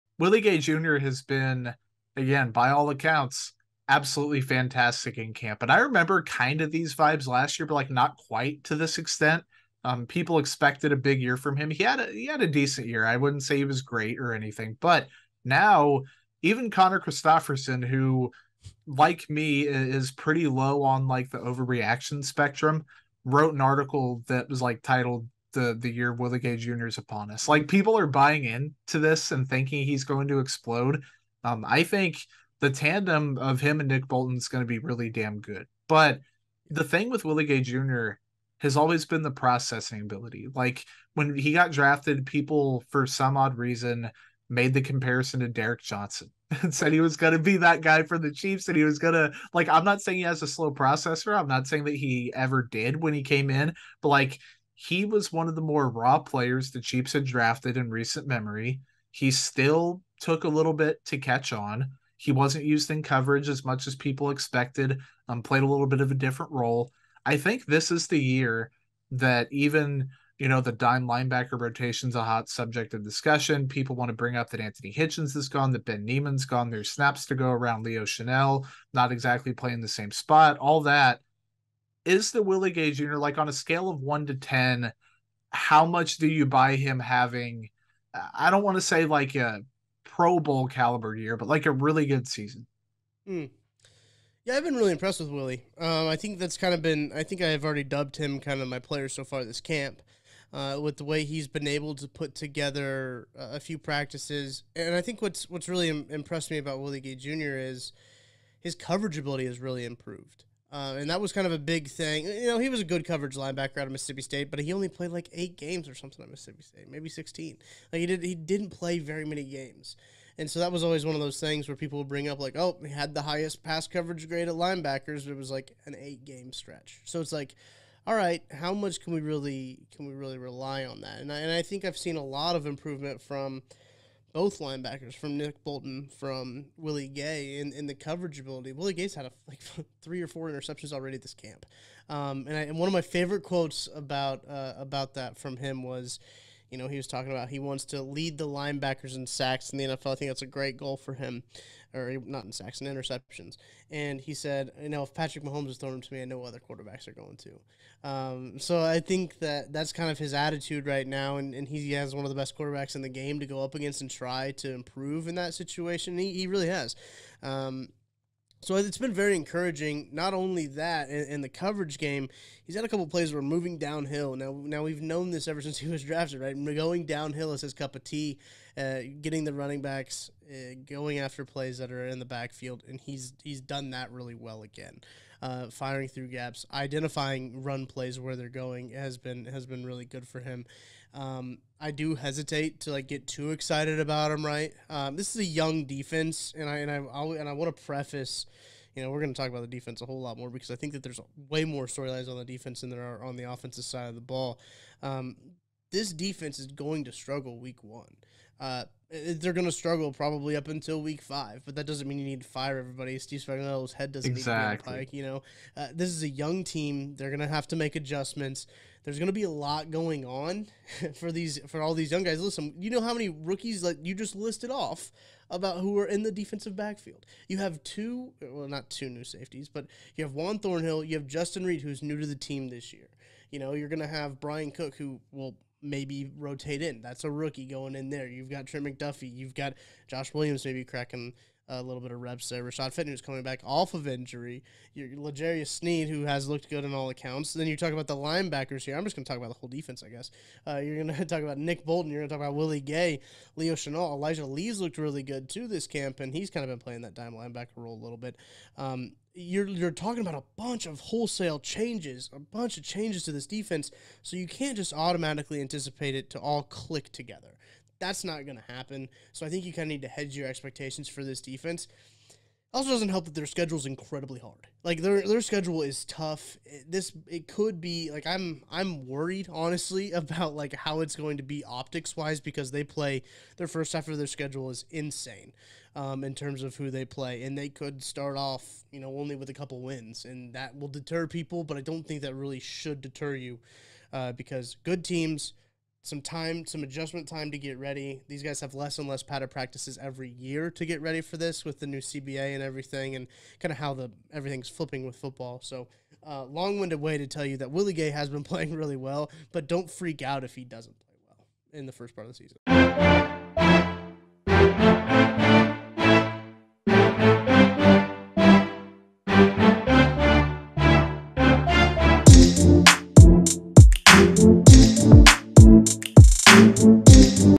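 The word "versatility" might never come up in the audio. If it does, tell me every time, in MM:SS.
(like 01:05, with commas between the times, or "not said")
not said.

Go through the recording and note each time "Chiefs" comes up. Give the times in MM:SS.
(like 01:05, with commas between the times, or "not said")
00:48, 00:56.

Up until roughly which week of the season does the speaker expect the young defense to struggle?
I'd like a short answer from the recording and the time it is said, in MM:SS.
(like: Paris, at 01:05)
week 5, at 03:31.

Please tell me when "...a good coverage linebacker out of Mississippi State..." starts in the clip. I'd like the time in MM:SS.
01:52.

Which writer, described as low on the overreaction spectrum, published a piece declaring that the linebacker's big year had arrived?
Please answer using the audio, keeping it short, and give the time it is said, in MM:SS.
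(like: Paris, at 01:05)
Conner Christopherson, at 00:16.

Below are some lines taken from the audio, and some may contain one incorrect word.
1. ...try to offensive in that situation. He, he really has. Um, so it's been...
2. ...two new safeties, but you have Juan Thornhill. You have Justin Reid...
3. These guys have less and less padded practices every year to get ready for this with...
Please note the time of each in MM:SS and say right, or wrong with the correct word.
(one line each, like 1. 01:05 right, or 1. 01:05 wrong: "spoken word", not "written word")
1. 02:44 wrong: "improve", not "offensive"
2. 03:48 right
3. 04:58 right.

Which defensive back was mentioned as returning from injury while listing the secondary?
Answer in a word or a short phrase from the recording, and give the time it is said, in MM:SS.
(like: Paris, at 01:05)
Rashad Fenton, at 04:02.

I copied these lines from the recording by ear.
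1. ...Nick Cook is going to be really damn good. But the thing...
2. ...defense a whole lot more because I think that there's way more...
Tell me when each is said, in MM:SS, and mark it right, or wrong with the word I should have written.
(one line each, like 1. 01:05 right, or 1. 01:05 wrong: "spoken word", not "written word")
1. 00:33 wrong: "Bolton", not "Cook"
2. 03:19 right.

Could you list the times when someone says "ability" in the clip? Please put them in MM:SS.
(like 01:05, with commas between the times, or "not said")
00:40, 01:49, 02:18.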